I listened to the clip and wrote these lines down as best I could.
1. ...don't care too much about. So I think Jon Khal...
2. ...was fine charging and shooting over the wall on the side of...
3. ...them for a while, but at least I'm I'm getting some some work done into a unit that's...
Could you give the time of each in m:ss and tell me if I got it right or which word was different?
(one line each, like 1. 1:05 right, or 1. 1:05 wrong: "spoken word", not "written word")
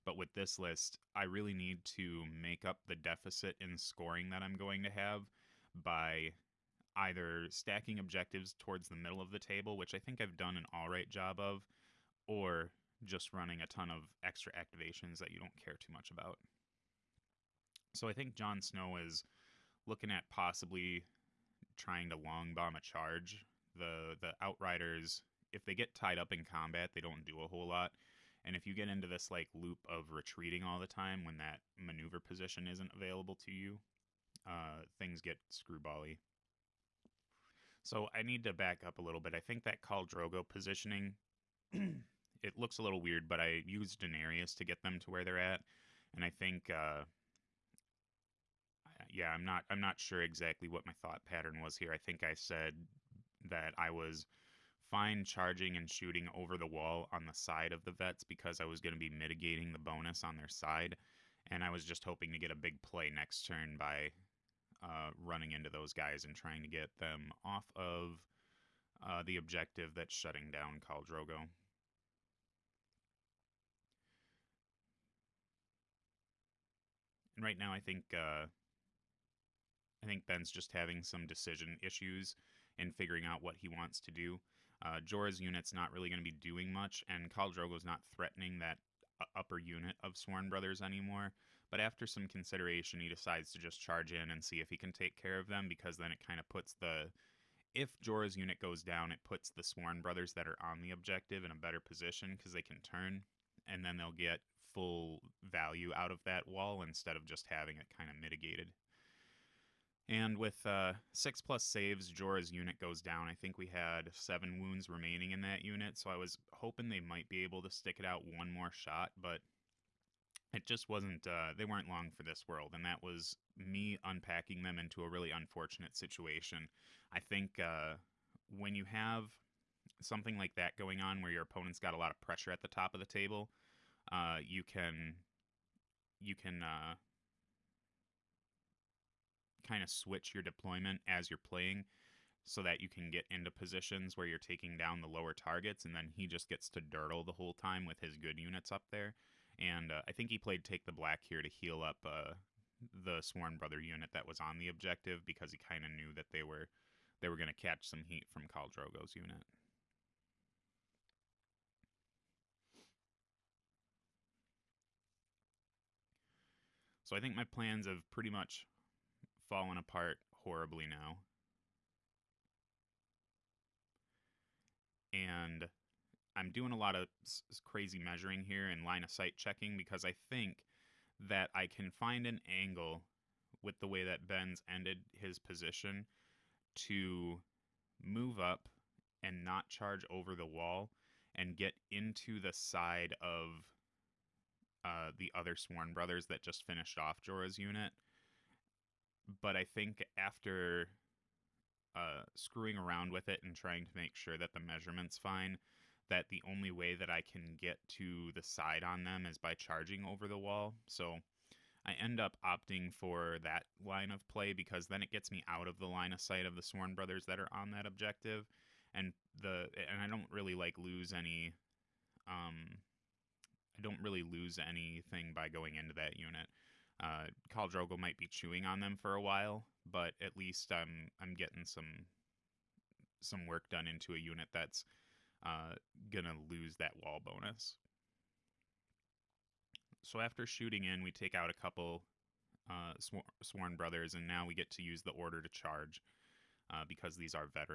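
1. 0:15 wrong: "Snow", not "Khal"
2. 0:53 right
3. 3:48 right.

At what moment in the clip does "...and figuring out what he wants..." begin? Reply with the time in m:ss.
1:22.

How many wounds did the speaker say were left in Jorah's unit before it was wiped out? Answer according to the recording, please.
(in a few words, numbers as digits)
7.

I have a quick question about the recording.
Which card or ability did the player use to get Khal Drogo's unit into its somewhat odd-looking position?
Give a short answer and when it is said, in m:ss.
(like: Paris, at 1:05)
Denarius, at 0:43.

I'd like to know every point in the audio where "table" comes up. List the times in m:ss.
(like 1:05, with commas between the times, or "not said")
0:09, 2:13.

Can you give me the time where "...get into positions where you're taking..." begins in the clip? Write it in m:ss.
2:23.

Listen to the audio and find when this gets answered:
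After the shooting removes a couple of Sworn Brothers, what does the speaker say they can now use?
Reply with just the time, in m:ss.
4:05.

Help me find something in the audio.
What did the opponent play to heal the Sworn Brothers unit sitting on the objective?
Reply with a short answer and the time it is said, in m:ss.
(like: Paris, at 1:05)
Take the Black, at 2:30.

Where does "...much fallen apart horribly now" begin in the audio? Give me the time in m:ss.
2:48.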